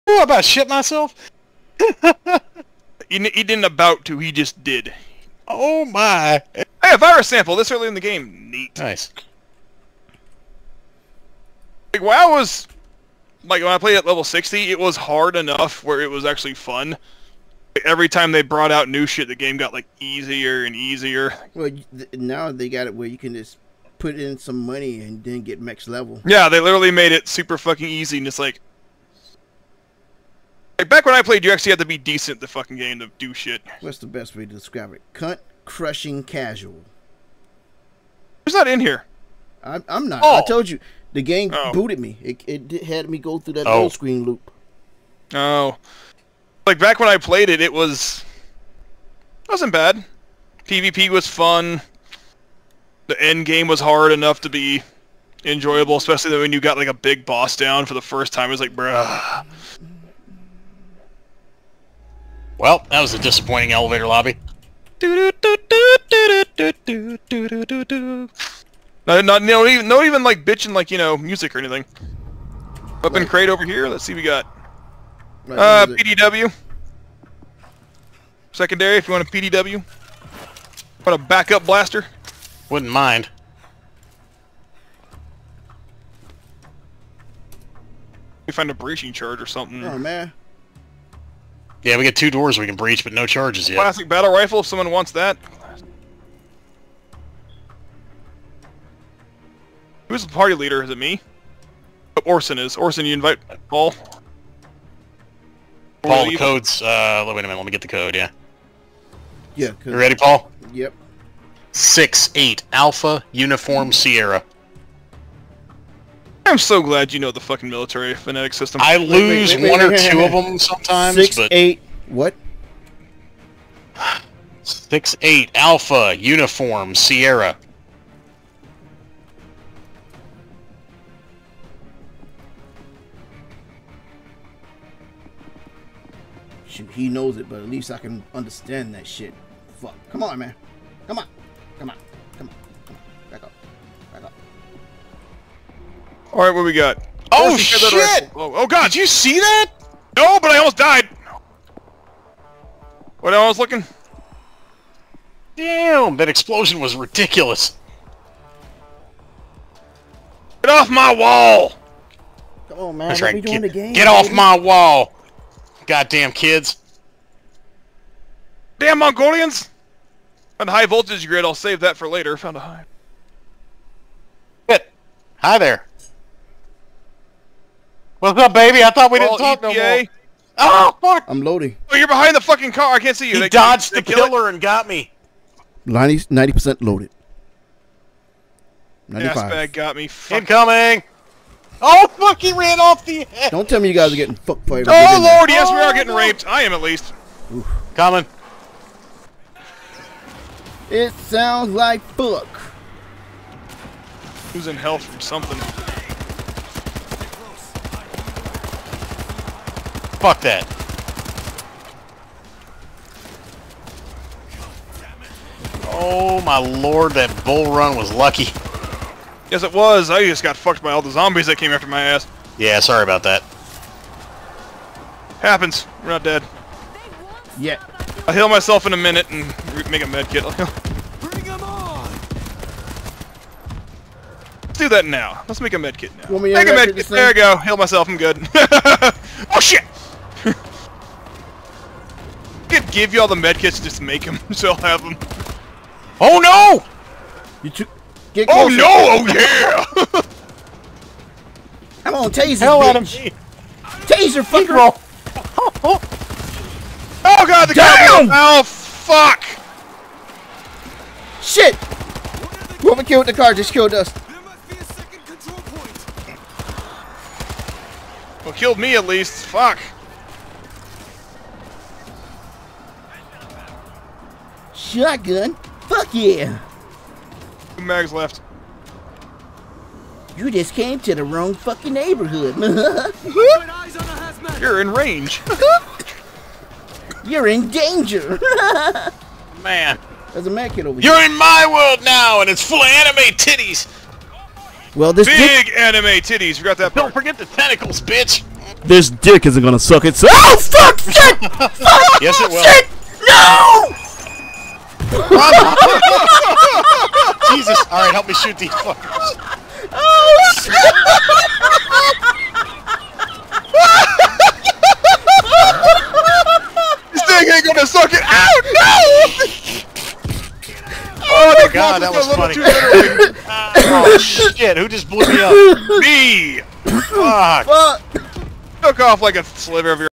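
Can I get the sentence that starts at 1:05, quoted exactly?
Not, not, no, even, even like bitching like, you know, music or anything.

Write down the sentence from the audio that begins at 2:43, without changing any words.
We doing get, the game, get off my wall!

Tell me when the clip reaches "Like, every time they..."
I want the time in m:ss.
0:16.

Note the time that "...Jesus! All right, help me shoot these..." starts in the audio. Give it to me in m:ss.
5:05.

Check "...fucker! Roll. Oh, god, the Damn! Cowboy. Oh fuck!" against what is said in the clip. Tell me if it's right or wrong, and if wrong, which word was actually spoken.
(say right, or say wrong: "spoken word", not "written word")
right.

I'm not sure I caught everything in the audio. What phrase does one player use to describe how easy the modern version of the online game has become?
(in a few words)
Cunt crushing casual.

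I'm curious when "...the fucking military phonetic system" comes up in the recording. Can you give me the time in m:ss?
1:57.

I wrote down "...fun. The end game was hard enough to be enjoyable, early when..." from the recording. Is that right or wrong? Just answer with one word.
wrong.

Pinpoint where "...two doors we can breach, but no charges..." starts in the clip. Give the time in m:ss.
1:32.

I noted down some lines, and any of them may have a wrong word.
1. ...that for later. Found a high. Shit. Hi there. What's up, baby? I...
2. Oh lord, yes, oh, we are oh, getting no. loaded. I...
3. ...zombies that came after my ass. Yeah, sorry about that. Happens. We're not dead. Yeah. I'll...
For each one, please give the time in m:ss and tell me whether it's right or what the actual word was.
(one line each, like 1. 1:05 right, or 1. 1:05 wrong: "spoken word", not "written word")
1. 2:51 right
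2. 3:14 wrong: "raped", not "loaded"
3. 3:41 right.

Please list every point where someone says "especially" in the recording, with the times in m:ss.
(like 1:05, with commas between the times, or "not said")
0:55.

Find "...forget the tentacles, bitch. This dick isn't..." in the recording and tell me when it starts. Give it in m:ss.
4:57.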